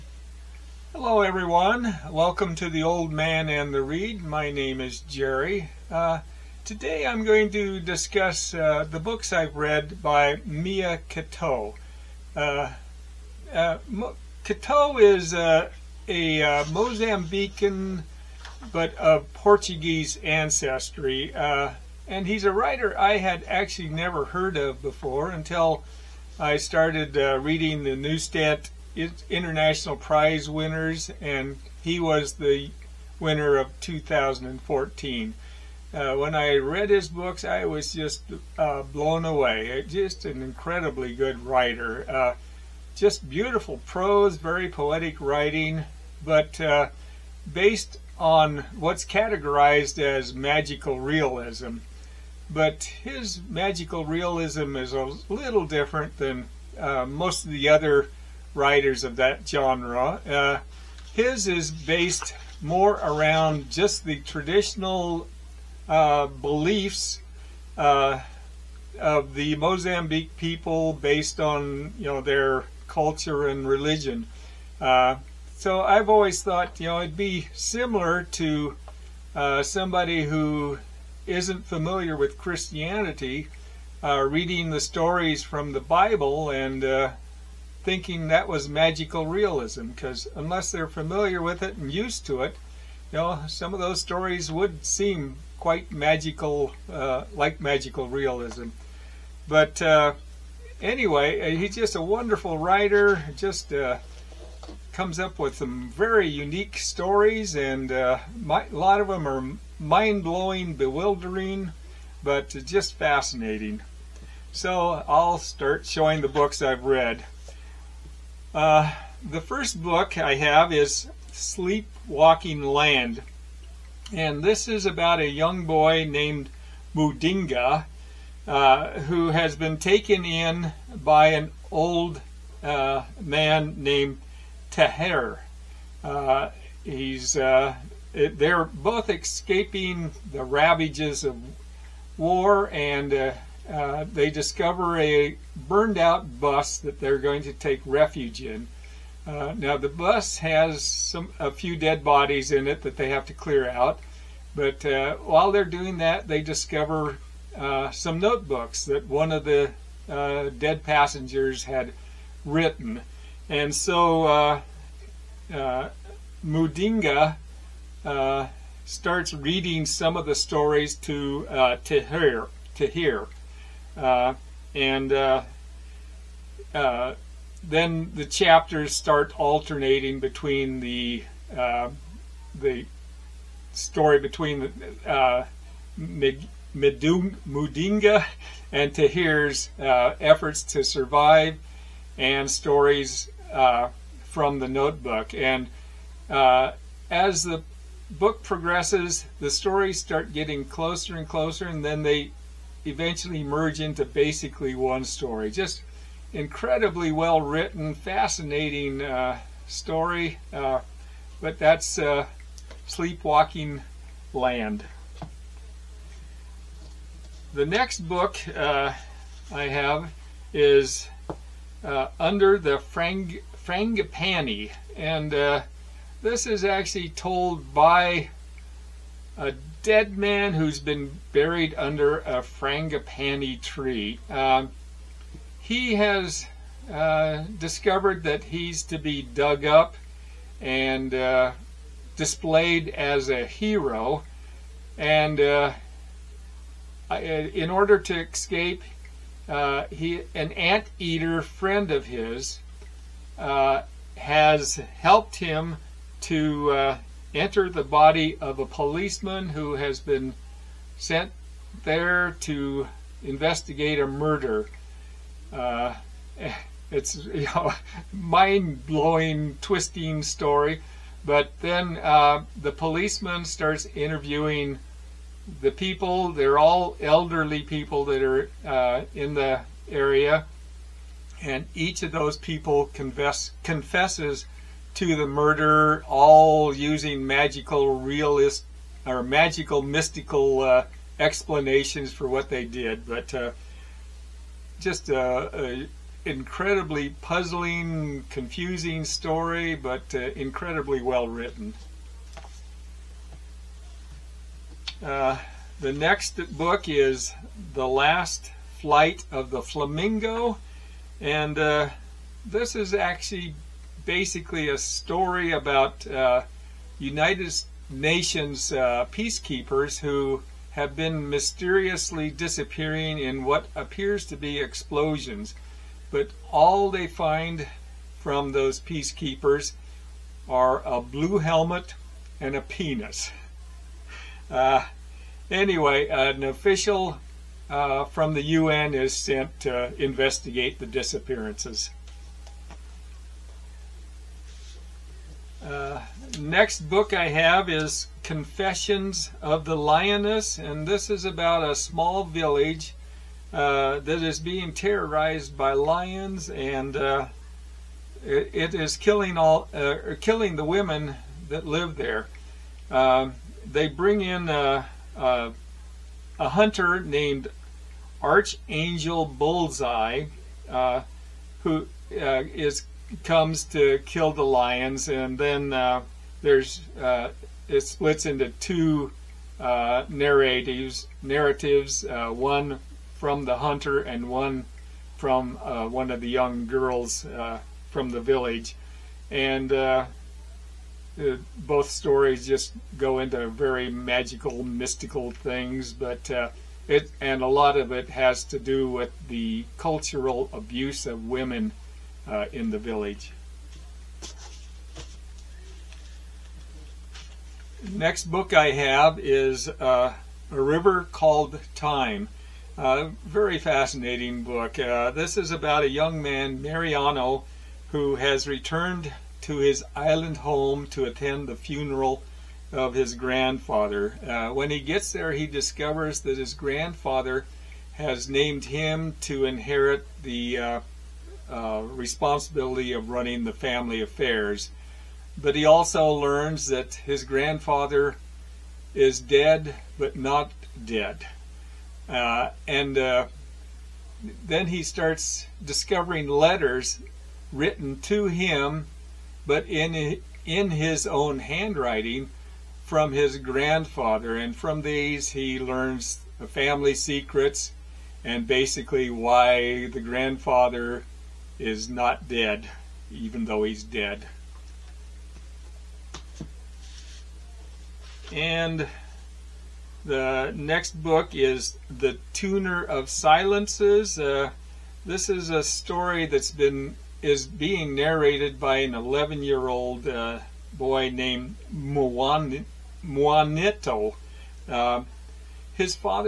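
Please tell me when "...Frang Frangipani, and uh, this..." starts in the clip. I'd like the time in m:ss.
3:42.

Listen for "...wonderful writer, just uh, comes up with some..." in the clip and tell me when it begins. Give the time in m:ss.
1:42.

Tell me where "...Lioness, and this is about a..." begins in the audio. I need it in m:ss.
5:49.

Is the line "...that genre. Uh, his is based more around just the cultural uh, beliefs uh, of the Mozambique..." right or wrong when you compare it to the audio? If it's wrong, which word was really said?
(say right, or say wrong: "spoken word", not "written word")
wrong: "traditional", not "cultural".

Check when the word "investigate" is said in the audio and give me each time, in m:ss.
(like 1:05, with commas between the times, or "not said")
4:23, 5:40.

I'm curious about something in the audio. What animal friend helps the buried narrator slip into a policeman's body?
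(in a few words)
an anteater.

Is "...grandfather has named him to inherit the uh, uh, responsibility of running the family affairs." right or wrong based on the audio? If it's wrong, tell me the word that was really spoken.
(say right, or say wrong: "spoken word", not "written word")
right.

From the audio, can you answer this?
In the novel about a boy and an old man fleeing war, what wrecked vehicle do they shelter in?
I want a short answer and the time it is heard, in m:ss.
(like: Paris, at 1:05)
a burned out bus, at 2:25.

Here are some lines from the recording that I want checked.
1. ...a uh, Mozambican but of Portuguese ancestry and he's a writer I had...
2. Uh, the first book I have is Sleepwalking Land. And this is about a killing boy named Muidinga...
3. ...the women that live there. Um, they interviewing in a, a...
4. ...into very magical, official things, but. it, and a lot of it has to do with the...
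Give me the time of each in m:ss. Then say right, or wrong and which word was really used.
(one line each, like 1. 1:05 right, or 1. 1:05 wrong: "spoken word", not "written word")
1. 0:16 right
2. 1:58 wrong: "young", not "killing"
3. 6:00 wrong: "bring", not "interviewing"
4. 6:33 wrong: "mystical", not "official".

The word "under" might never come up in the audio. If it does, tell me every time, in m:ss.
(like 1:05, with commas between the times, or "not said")
3:42, 3:51.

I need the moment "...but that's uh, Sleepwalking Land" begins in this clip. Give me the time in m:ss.
3:31.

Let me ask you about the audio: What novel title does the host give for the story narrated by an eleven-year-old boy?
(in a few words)
The Tuner of Silences.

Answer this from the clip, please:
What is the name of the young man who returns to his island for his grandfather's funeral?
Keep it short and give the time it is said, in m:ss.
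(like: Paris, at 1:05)
Mariano, at 6:56.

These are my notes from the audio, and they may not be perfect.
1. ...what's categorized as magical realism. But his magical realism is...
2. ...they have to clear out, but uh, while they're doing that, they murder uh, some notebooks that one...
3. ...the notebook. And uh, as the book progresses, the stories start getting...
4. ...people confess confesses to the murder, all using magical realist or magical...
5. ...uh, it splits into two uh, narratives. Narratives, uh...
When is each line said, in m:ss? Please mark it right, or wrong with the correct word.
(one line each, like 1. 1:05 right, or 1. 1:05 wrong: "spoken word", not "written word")
1. 0:48 right
2. 2:32 wrong: "discover", not "murder"
3. 3:14 right
4. 4:42 right
5. 6:16 right.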